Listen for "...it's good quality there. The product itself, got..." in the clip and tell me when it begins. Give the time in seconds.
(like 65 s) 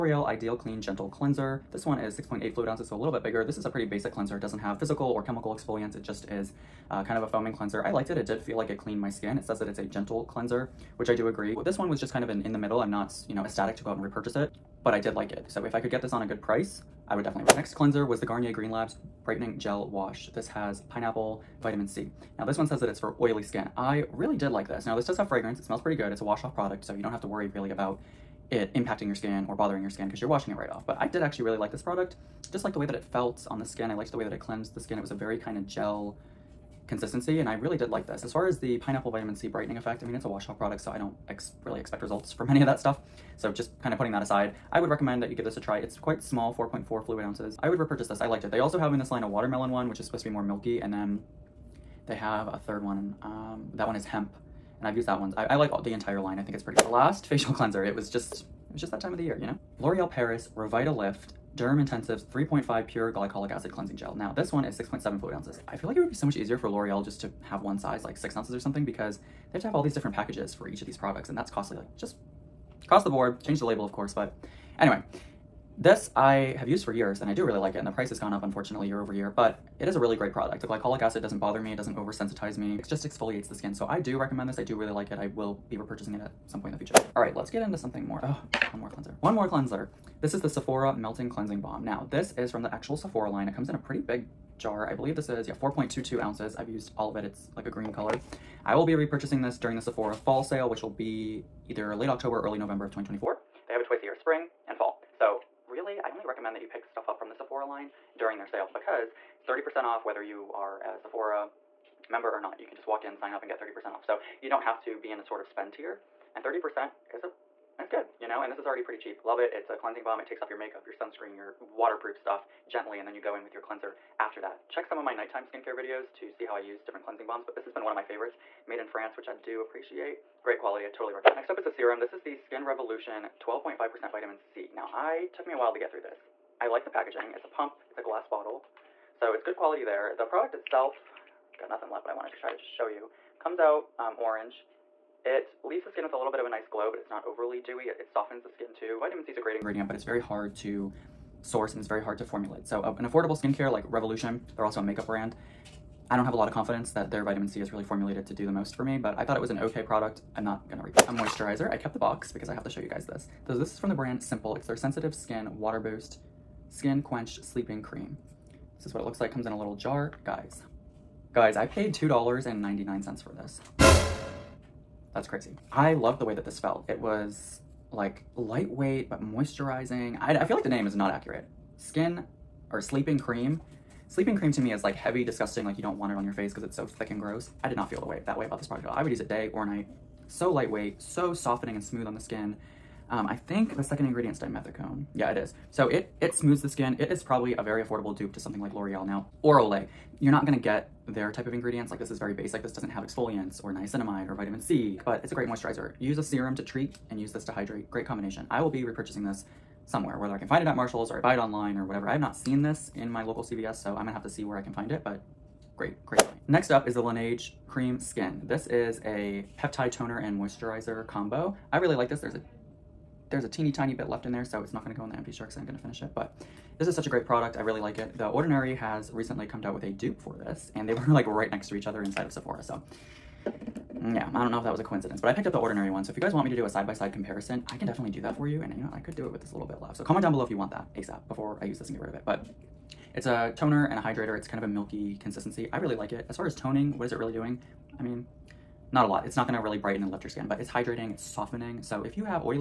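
139 s.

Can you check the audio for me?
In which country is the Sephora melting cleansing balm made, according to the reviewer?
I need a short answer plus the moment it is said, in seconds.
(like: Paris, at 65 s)
France, at 128 s.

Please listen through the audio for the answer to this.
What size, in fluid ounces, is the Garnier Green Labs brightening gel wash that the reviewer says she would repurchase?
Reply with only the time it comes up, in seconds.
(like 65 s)
46 s.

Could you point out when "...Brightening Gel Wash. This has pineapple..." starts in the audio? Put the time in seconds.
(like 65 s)
19 s.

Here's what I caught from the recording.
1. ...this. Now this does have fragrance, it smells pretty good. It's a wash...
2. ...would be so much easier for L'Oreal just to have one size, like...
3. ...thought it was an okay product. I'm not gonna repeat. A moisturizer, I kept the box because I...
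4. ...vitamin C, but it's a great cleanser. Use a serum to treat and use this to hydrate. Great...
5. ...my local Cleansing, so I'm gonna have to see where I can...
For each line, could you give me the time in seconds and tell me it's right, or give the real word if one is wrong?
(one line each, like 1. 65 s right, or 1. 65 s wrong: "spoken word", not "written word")
1. 24 s right
2. 66 s right
3. 159 s right
4. 204 s wrong: "moisturizer", not "cleanser"
5. 213 s wrong: "CVS", not "Cleansing".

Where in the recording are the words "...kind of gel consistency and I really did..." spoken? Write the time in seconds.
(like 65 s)
35 s.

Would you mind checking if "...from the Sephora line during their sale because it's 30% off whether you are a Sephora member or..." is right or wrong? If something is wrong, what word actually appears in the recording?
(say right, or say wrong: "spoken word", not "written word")
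right.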